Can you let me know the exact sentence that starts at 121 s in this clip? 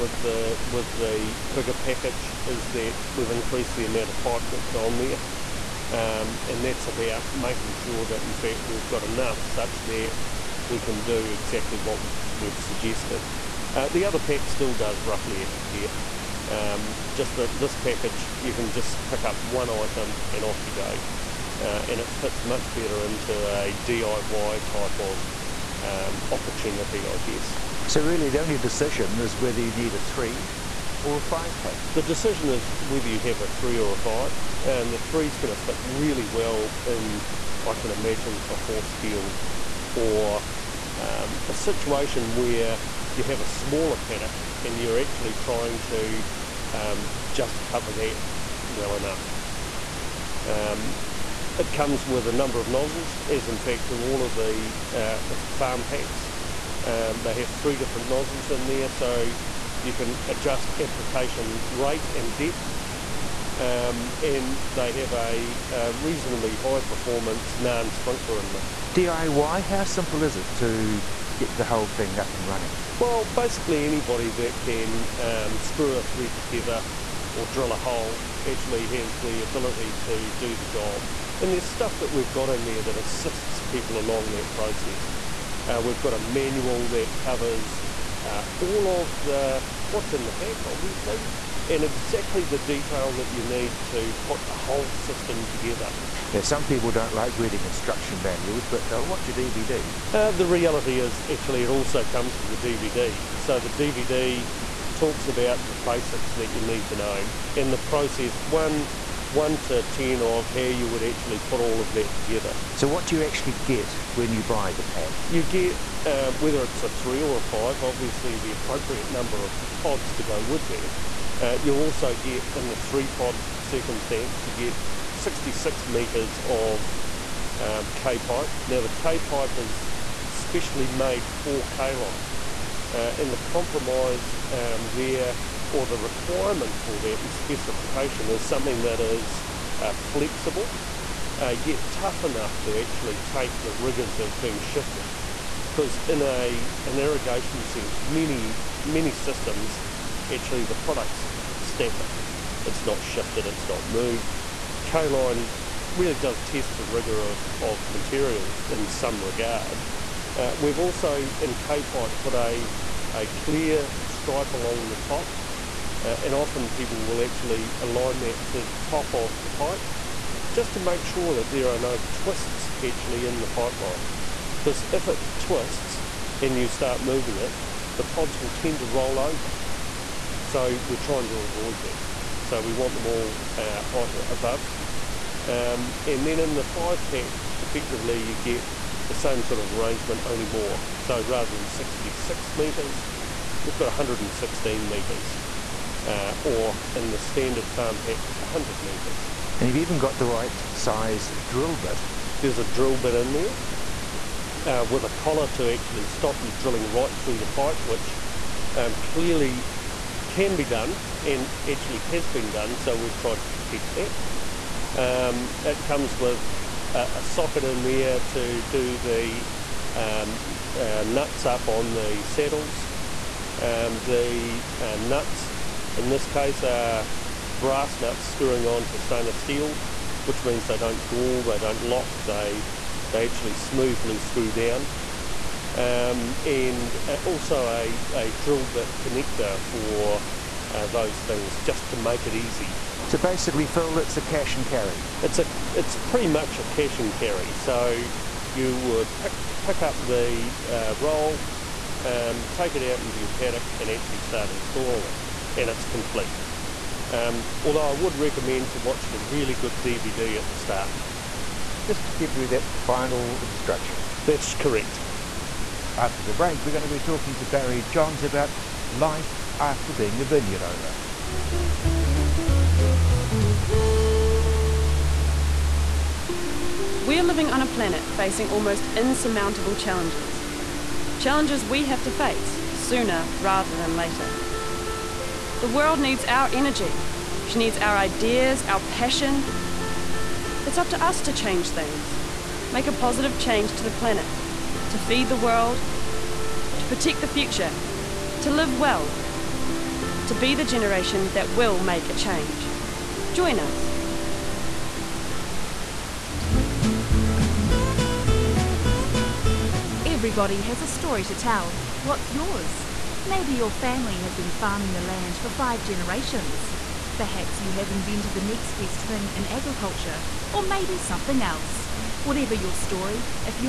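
Uh, you also get, in the three pod circumstance, you get 66 metres of um, K pipe.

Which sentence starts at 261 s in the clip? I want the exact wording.
Just to give you that final instruction.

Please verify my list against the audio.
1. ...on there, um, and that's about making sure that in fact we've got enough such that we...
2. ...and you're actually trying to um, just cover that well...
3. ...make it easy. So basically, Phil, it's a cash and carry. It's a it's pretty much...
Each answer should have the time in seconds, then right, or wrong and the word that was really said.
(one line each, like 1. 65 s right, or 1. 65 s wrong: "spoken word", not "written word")
1. 4 s right
2. 44 s right
3. 241 s right.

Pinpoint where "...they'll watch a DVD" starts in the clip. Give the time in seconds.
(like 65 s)
98 s.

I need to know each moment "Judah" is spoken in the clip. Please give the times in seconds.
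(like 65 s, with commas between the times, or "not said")
not said.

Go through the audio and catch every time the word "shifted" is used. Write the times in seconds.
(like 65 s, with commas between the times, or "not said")
144 s, 153 s.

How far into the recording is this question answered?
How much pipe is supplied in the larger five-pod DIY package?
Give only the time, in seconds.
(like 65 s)
193 s.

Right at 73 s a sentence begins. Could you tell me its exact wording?
Well, basically anybody that can um, screw a thread together or drill a hole actually has the ability to do the job.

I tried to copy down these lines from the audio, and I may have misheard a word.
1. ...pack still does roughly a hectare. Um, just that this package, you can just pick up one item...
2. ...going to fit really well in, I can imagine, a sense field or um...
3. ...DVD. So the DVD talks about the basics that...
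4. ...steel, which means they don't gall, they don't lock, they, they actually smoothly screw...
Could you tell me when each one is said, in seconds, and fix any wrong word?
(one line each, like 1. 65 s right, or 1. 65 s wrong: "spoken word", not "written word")
1. 14 s right
2. 35 s wrong: "horse", not "sense"
3. 102 s right
4. 229 s right.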